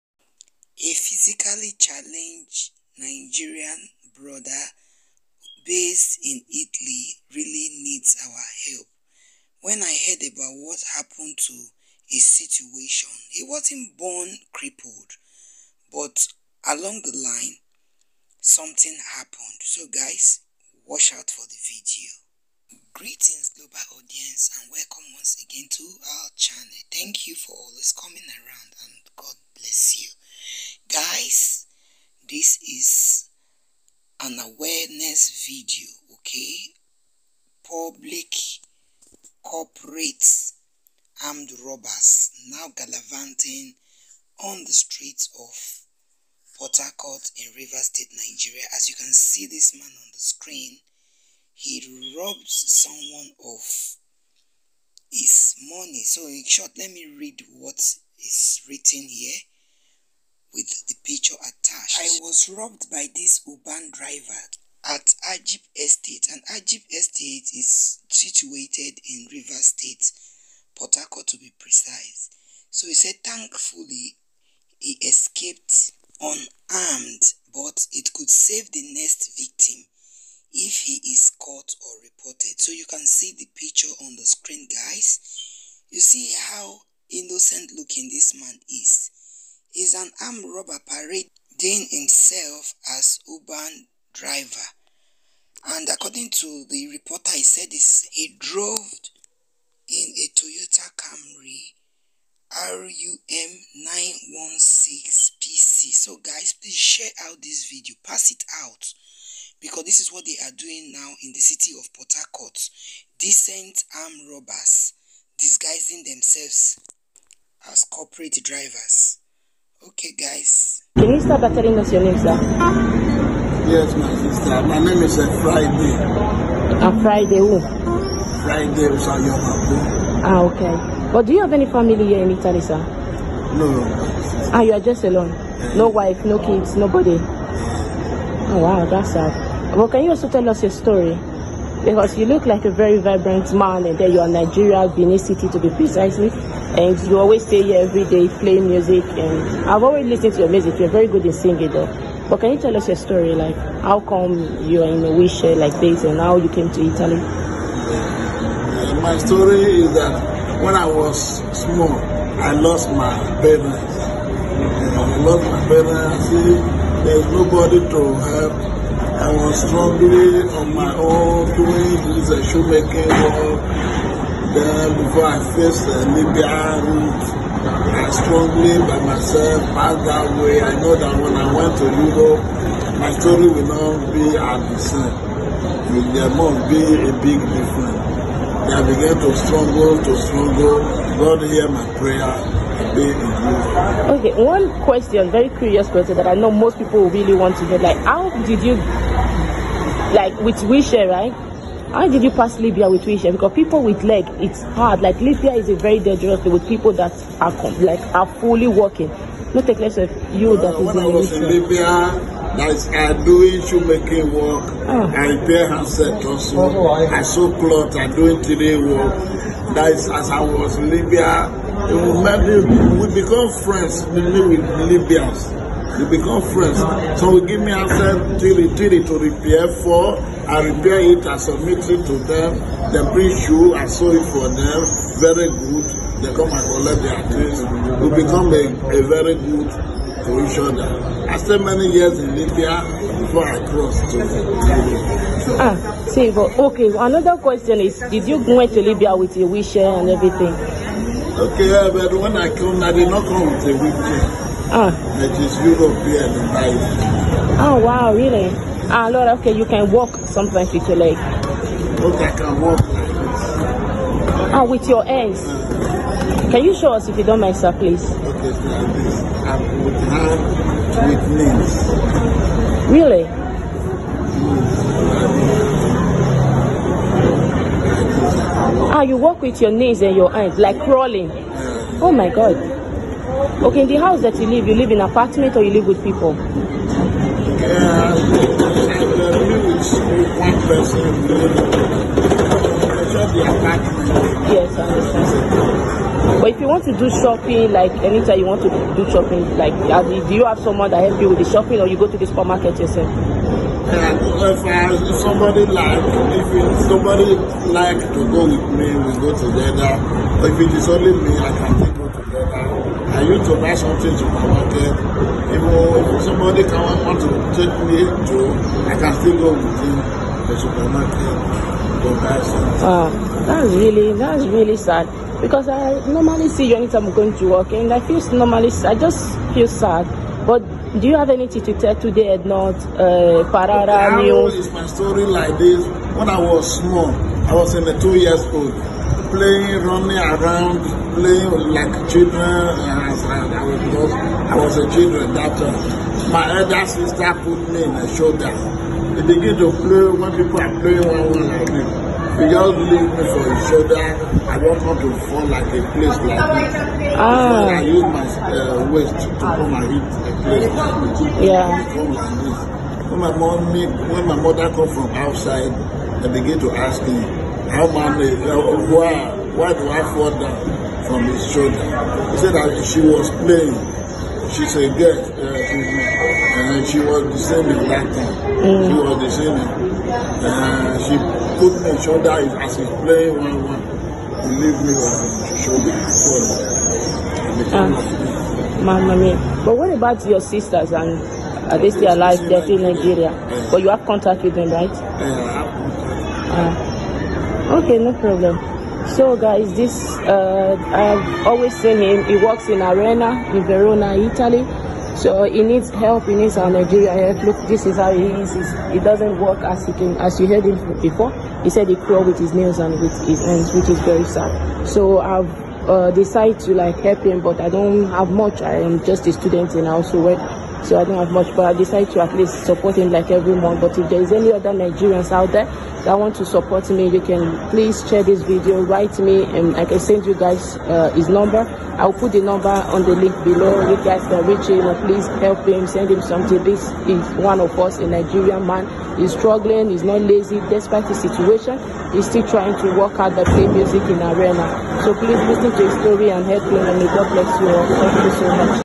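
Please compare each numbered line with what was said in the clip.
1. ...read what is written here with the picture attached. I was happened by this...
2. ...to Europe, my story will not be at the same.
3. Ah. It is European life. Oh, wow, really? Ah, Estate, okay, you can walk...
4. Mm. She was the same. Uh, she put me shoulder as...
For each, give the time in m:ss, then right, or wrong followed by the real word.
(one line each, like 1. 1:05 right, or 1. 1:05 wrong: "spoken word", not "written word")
1. 0:57 wrong: "robbed", not "happened"
2. 3:01 right
3. 4:14 wrong: "Lord", not "Estate"
4. 6:18 right.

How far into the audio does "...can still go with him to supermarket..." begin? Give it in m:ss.
5:18.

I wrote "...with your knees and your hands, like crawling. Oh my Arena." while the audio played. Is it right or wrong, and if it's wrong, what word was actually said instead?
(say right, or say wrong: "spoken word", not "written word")
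wrong: "God", not "Arena".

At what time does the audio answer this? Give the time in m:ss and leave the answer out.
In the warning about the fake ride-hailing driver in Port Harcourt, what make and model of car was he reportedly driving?
1:40.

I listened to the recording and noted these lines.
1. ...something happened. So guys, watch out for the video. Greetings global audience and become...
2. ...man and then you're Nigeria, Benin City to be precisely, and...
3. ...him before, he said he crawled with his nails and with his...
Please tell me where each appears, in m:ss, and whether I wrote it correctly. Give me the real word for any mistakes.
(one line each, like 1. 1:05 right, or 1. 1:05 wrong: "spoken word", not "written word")
1. 0:18 wrong: "welcome", not "become"
2. 2:23 right
3. 6:50 right.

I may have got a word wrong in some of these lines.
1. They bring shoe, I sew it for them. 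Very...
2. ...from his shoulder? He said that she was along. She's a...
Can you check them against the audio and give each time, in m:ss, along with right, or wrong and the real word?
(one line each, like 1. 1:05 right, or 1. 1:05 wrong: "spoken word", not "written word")
1. 3:52 right
2. 6:11 wrong: "playing", not "along".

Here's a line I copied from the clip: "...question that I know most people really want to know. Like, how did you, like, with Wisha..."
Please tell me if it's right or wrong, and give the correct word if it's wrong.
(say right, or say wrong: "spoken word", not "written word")
right.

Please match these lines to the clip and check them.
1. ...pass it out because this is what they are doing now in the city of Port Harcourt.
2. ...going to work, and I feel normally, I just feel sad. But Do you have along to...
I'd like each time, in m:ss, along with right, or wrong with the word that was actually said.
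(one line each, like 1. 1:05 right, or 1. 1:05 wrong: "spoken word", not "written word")
1. 1:48 right
2. 5:27 wrong: "anything", not "along".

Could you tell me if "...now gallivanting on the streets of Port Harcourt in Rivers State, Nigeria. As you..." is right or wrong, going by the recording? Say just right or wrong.
right.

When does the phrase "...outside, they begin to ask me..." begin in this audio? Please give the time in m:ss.
6:05.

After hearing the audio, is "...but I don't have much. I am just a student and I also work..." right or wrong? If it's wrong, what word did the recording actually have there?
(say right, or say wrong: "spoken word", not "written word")
right.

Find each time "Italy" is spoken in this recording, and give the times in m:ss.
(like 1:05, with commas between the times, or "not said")
0:06, 2:12, 2:36, 6:44.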